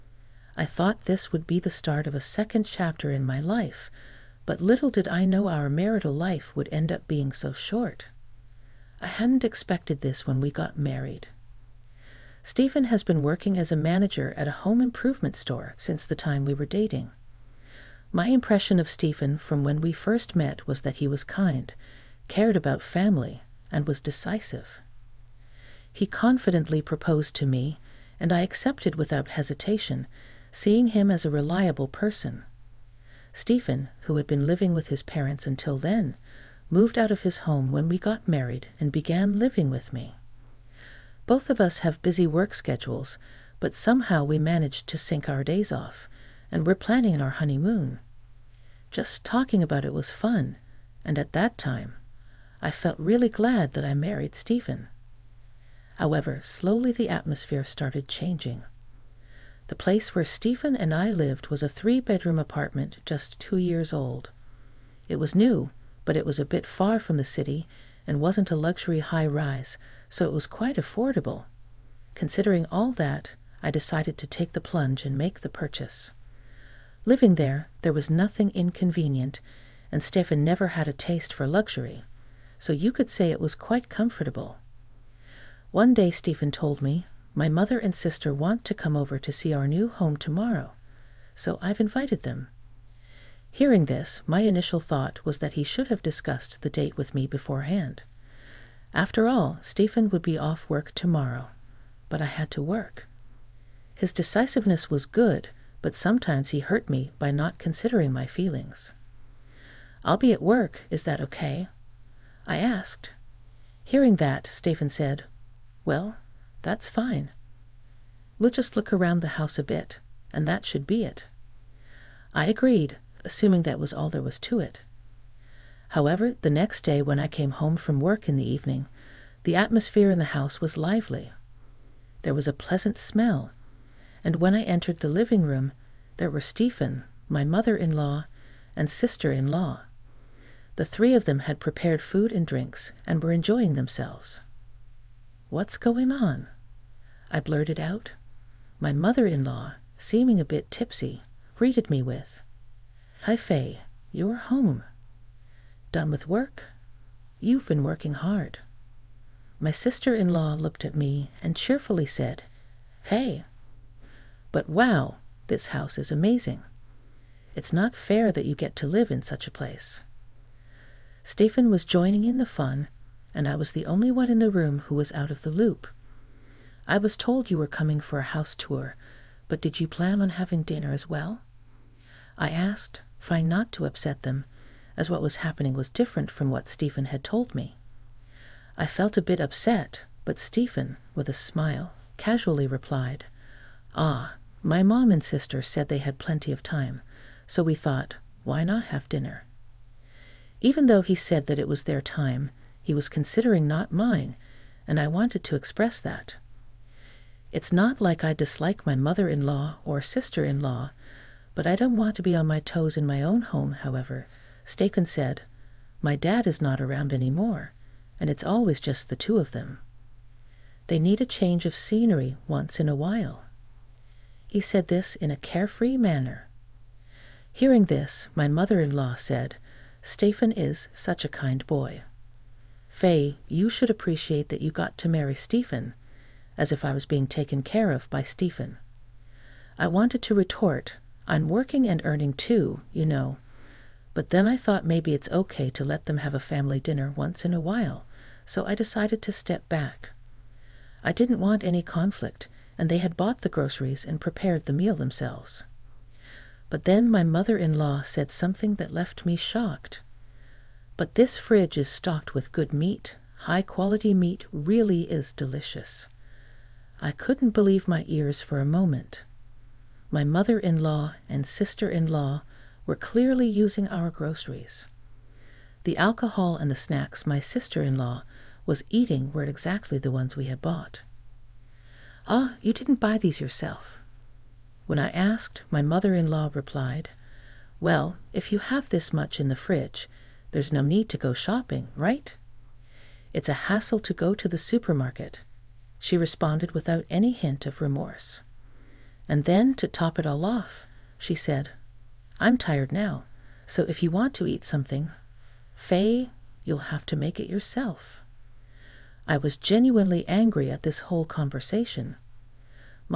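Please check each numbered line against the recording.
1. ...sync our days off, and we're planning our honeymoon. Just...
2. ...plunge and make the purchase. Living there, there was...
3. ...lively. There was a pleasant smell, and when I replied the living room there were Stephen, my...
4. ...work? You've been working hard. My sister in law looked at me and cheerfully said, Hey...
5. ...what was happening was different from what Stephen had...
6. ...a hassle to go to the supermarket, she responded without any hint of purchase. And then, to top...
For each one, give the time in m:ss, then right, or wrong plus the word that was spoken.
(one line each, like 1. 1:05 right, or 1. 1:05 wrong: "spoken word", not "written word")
1. 0:44 right
2. 1:14 right
3. 2:10 wrong: "entered", not "replied"
4. 2:36 right
5. 3:05 right
6. 4:53 wrong: "remorse", not "purchase".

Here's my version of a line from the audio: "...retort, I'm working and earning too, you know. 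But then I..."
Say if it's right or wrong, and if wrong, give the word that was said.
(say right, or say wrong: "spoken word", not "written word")
right.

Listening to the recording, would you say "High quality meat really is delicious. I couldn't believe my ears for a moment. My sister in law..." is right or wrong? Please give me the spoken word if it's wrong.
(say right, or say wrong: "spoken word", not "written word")
wrong: "mother", not "sister".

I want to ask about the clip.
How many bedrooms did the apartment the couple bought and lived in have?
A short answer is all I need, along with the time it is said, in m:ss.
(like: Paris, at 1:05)
3, at 1:01.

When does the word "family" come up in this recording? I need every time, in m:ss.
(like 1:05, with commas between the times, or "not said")
0:22, 4:06.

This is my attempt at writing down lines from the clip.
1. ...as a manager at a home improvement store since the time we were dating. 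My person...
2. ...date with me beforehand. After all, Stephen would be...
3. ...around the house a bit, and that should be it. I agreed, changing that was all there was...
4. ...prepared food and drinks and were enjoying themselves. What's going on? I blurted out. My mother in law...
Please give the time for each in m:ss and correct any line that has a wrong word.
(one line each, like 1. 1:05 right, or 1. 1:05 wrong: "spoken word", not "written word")
1. 0:13 wrong: "impression", not "person"
2. 1:36 right
3. 1:58 wrong: "assuming", not "changing"
4. 2:21 right.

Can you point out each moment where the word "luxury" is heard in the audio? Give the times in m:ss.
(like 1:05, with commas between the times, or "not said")
1:08, 1:21.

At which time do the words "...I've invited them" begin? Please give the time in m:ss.
1:31.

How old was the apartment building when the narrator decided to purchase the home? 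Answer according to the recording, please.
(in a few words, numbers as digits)
2 years.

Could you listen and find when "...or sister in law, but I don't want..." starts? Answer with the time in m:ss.
3:29.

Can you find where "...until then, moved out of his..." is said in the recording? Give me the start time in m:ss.
0:35.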